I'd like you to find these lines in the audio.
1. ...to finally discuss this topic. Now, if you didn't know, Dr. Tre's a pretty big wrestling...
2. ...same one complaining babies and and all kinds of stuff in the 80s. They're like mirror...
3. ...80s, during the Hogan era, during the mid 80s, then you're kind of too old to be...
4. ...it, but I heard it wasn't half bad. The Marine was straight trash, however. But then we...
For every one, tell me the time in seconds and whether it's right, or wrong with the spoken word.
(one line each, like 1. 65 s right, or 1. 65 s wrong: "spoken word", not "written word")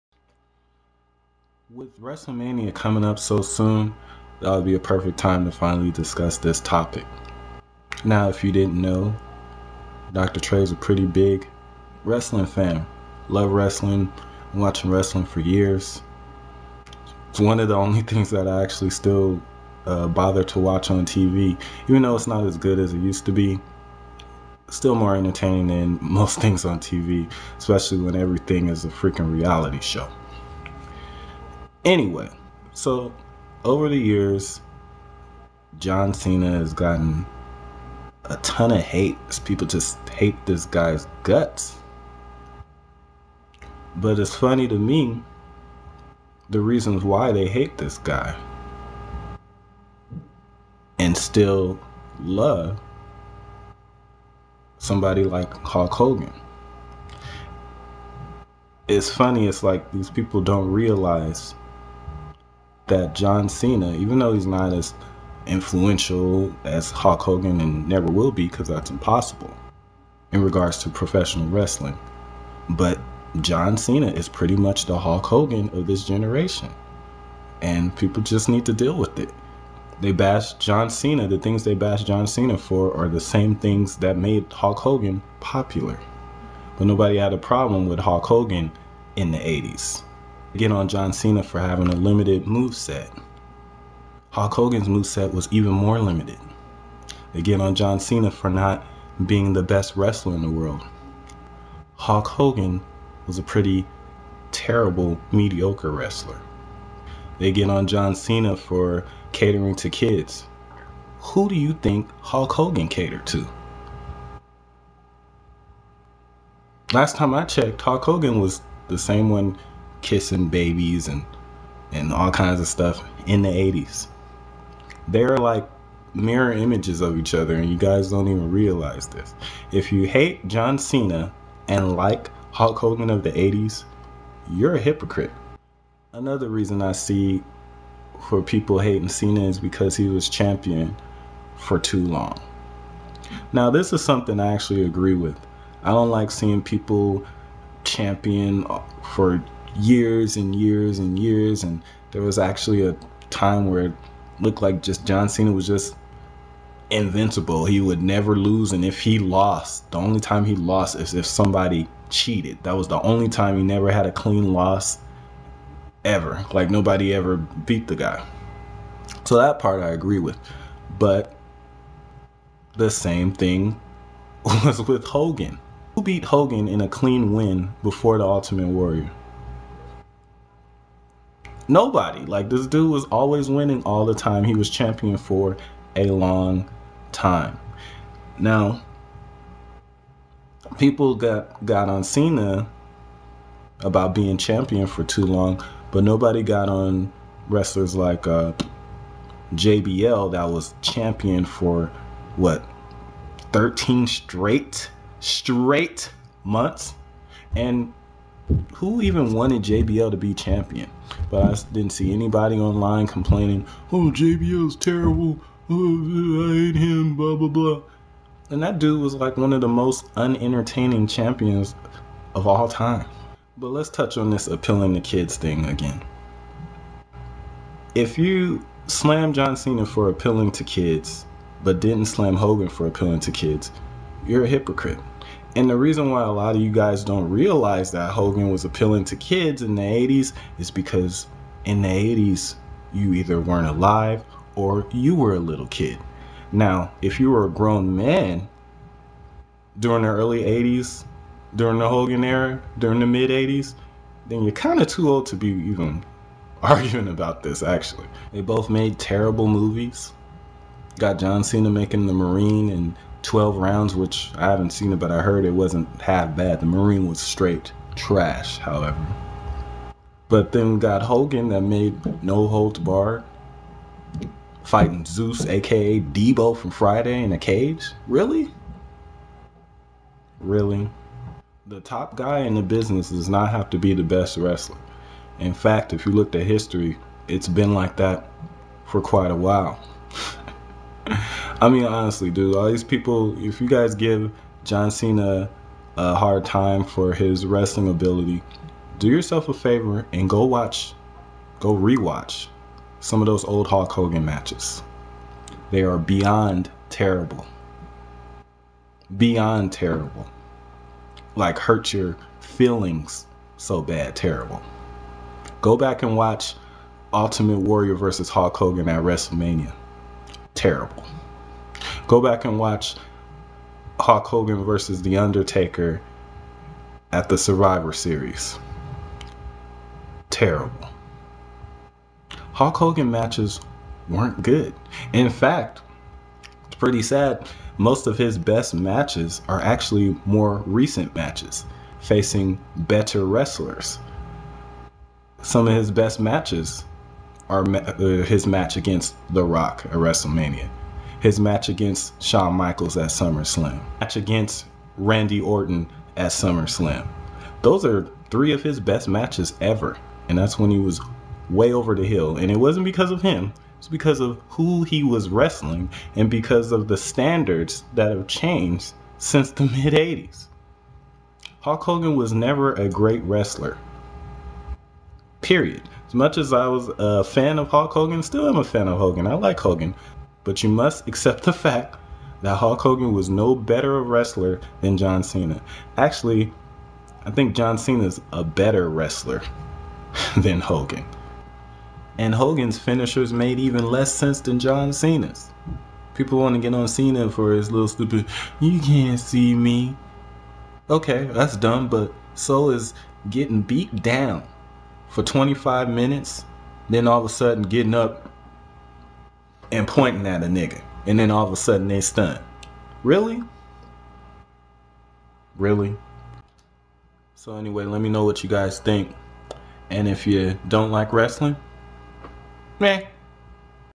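1. 5 s right
2. 118 s wrong: "kissing", not "complaining"
3. 250 s right
4. 264 s right.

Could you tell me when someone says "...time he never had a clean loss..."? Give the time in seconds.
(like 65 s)
163 s.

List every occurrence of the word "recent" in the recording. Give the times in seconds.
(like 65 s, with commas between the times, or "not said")
340 s.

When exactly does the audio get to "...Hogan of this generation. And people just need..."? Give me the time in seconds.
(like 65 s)
75 s.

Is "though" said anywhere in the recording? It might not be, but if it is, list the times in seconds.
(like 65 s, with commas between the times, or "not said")
22 s, 64 s.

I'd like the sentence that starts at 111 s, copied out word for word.
Who do you think Hulk Hogan catered to?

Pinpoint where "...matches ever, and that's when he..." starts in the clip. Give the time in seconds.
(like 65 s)
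359 s.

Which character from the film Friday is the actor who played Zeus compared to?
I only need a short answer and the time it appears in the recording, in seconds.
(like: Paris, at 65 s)
Debo, at 275 s.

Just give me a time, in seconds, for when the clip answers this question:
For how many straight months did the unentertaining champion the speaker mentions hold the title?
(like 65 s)
203 s.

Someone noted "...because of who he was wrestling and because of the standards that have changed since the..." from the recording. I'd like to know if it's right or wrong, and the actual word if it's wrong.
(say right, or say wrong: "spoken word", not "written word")
right.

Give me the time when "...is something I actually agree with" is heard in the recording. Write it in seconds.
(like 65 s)
143 s.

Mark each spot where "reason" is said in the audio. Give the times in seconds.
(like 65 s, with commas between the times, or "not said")
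46 s, 136 s, 235 s.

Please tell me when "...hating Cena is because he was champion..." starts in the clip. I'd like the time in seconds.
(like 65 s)
138 s.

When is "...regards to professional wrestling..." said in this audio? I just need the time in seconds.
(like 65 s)
70 s.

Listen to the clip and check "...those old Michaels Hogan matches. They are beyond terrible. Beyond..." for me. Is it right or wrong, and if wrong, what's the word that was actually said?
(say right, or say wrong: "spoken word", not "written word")
wrong: "Hulk", not "Michaels".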